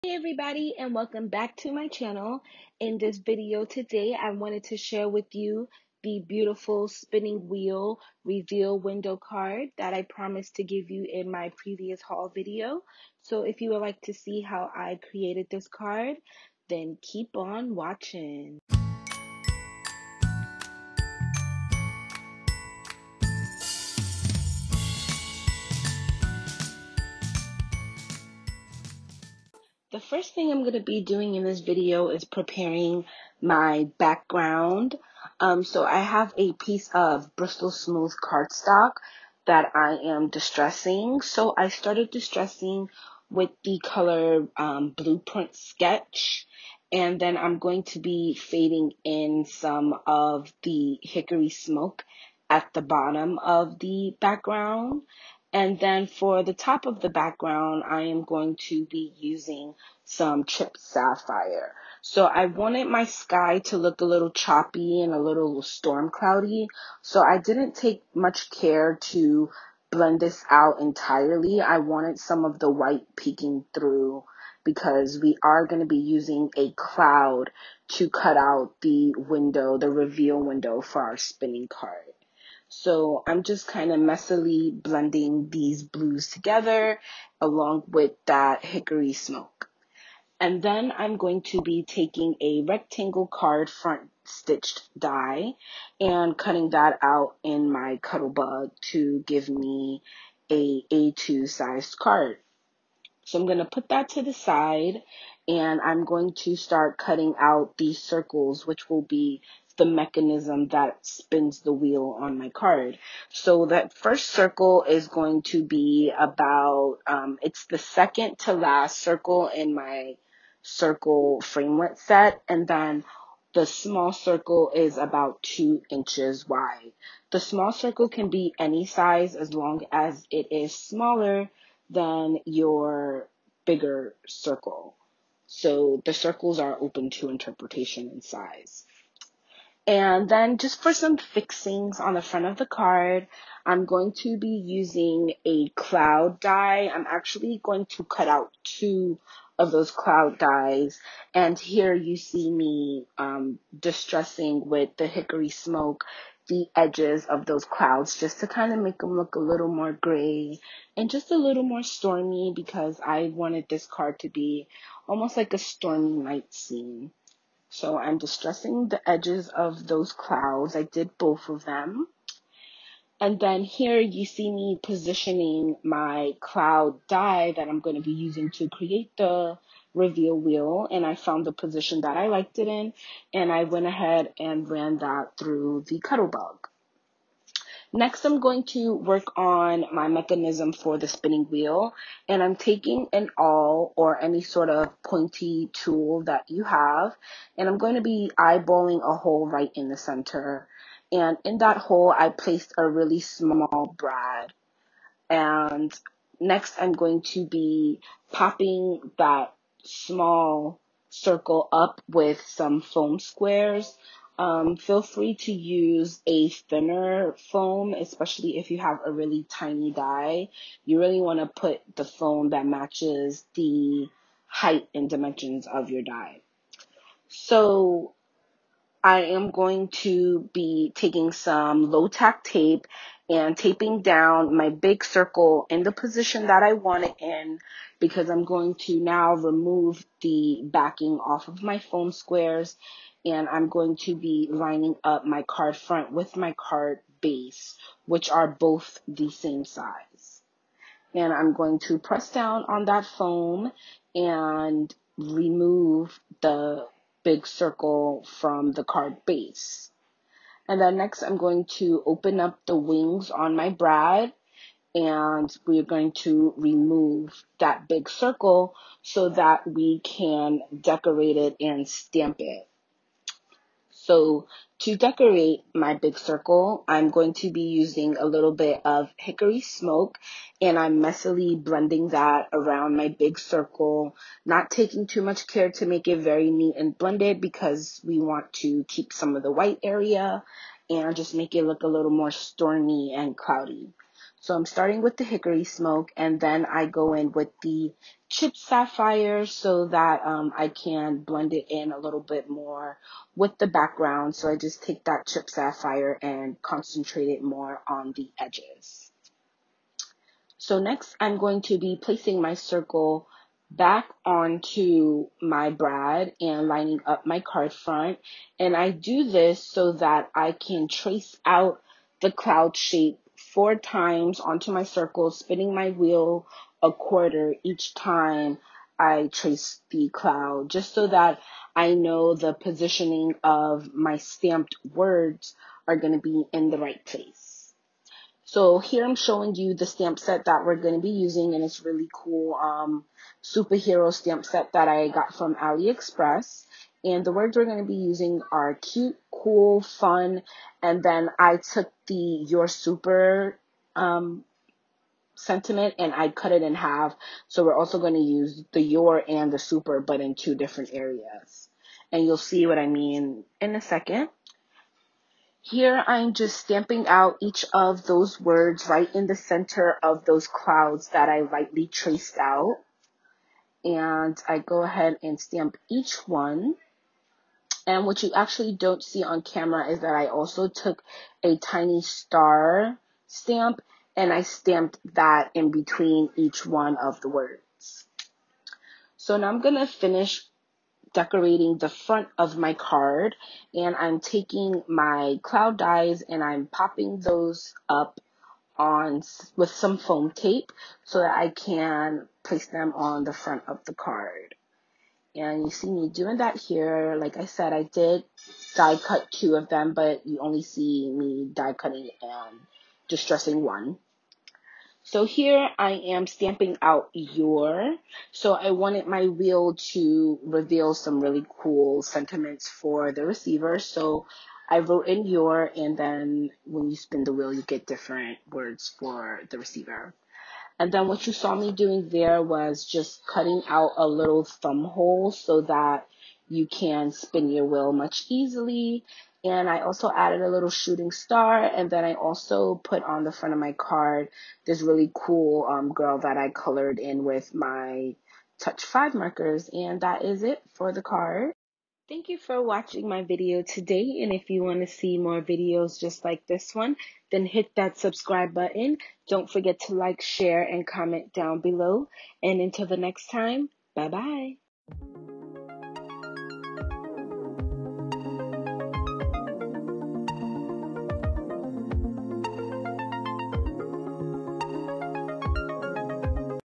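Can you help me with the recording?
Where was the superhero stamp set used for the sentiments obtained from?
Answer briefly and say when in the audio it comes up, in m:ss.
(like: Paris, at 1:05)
AliExpress, at 5:45.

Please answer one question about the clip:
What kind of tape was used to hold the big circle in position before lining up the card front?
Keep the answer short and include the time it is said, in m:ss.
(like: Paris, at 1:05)
Low tack tape, at 3:51.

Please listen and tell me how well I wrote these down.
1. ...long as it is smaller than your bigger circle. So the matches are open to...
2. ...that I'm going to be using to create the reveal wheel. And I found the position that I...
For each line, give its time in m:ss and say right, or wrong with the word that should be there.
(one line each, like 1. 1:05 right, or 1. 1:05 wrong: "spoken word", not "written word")
1. 2:09 wrong: "circles", not "matches"
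2. 2:57 right.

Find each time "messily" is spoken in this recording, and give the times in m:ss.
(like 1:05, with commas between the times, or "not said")
1:23, 4:40.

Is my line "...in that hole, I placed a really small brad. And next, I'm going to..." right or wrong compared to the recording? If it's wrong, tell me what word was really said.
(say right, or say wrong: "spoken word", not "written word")
right.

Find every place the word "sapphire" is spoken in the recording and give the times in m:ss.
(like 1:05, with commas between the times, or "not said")
1:00, 4:58, 5:05.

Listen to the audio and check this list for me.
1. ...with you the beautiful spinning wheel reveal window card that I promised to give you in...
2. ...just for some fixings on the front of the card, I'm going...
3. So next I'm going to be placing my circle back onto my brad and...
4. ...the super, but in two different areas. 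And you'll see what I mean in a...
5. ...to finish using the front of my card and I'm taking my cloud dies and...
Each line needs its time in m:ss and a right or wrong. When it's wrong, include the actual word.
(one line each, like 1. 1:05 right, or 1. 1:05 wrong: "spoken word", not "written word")
1. 0:05 right
2. 2:20 right
3. 5:10 right
4. 5:59 right
5. 6:29 wrong: "decorating", not "using".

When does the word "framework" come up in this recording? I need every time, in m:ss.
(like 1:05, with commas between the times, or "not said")
2:01.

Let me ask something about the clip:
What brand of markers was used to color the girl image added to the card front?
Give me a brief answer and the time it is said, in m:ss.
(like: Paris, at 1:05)
Touch 5, at 7:28.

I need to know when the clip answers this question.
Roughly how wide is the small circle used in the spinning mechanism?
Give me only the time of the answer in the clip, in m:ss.
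2:05.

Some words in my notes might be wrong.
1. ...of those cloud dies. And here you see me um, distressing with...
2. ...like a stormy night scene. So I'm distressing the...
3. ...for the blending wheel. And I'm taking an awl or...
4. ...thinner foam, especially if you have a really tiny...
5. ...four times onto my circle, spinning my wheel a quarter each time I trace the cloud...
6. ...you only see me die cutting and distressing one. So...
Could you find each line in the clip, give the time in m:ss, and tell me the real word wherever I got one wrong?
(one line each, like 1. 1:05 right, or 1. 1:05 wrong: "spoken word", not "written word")
1. 2:29 right
2. 2:45 right
3. 3:10 wrong: "spinning", not "blending"
4. 3:36 right
5. 5:23 right
6. 6:50 right.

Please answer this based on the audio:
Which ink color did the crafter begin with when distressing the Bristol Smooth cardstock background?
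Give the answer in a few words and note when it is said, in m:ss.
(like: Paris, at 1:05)
Blueprint Sketch, at 0:44.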